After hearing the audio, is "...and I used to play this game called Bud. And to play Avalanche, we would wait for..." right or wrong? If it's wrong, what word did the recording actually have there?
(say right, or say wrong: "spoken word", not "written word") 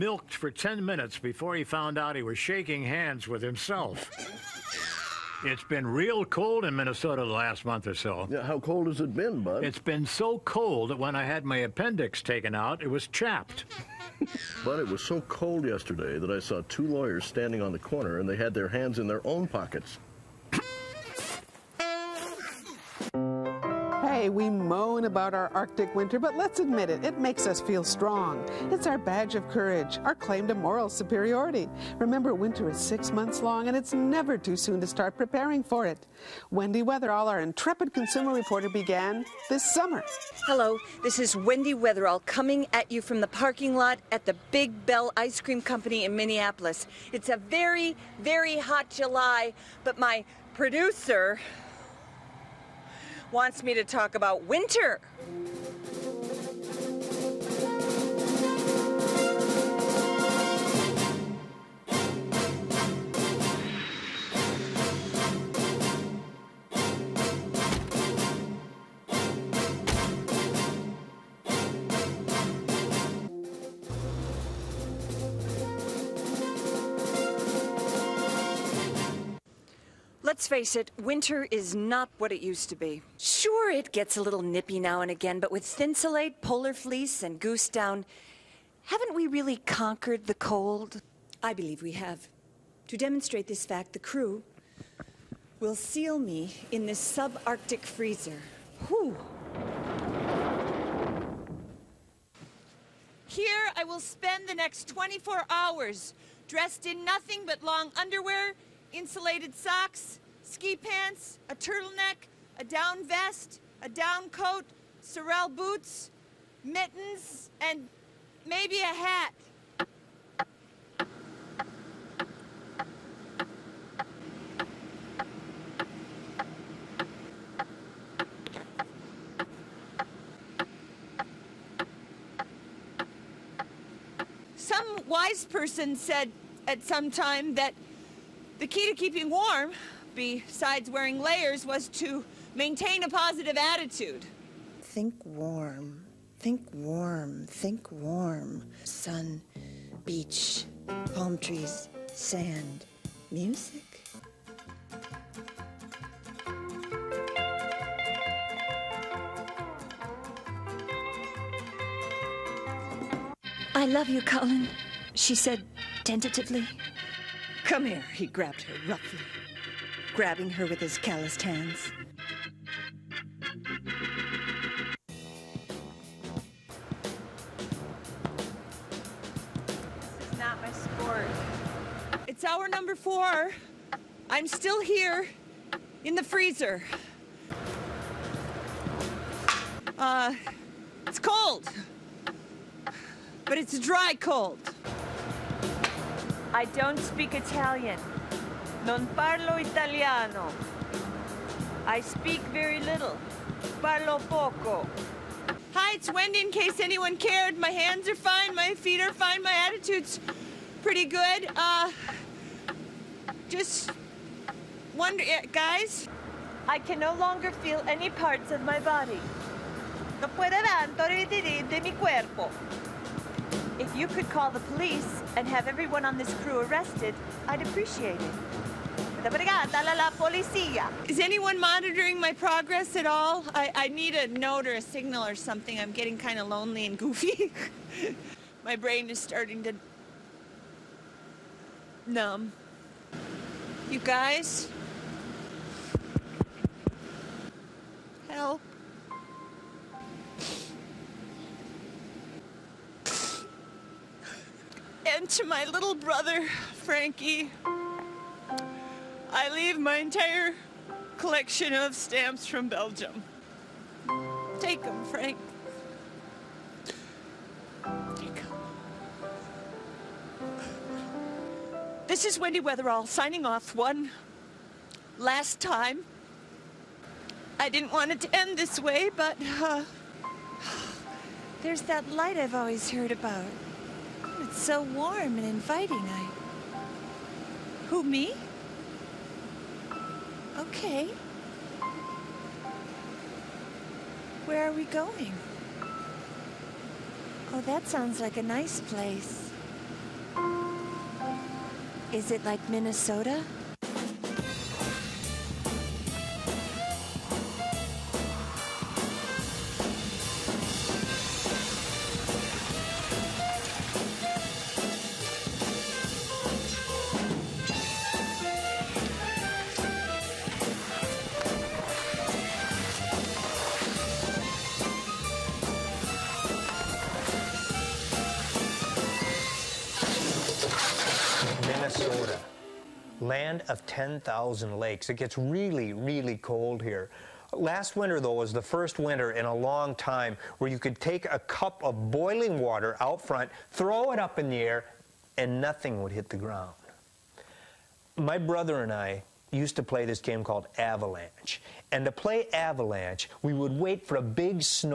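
wrong: "Avalanche", not "Bud".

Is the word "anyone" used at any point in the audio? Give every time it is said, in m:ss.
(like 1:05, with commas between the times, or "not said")
3:26, 3:51.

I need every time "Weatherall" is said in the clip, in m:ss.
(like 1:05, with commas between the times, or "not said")
0:36, 0:41, 4:32.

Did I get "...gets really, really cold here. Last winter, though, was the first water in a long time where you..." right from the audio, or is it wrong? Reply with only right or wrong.
wrong.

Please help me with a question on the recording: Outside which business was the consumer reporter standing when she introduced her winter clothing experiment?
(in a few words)
Big Bell Ice Cream Company.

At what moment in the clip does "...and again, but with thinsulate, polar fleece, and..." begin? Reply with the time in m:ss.
1:25.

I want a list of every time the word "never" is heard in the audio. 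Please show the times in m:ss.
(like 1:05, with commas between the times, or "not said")
0:33.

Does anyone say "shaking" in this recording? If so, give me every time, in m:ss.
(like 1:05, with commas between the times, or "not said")
0:02.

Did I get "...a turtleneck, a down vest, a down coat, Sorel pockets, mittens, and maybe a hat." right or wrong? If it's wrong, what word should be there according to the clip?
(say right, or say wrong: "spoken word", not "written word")
wrong: "boots", not "pockets".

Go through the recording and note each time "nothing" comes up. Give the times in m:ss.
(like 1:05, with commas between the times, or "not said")
1:47, 5:45.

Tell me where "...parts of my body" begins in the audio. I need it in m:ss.
3:38.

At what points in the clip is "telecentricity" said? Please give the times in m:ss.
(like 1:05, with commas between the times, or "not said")
not said.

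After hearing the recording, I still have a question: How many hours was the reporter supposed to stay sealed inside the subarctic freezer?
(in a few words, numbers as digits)
24.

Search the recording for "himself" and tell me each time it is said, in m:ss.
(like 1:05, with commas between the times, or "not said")
0:03.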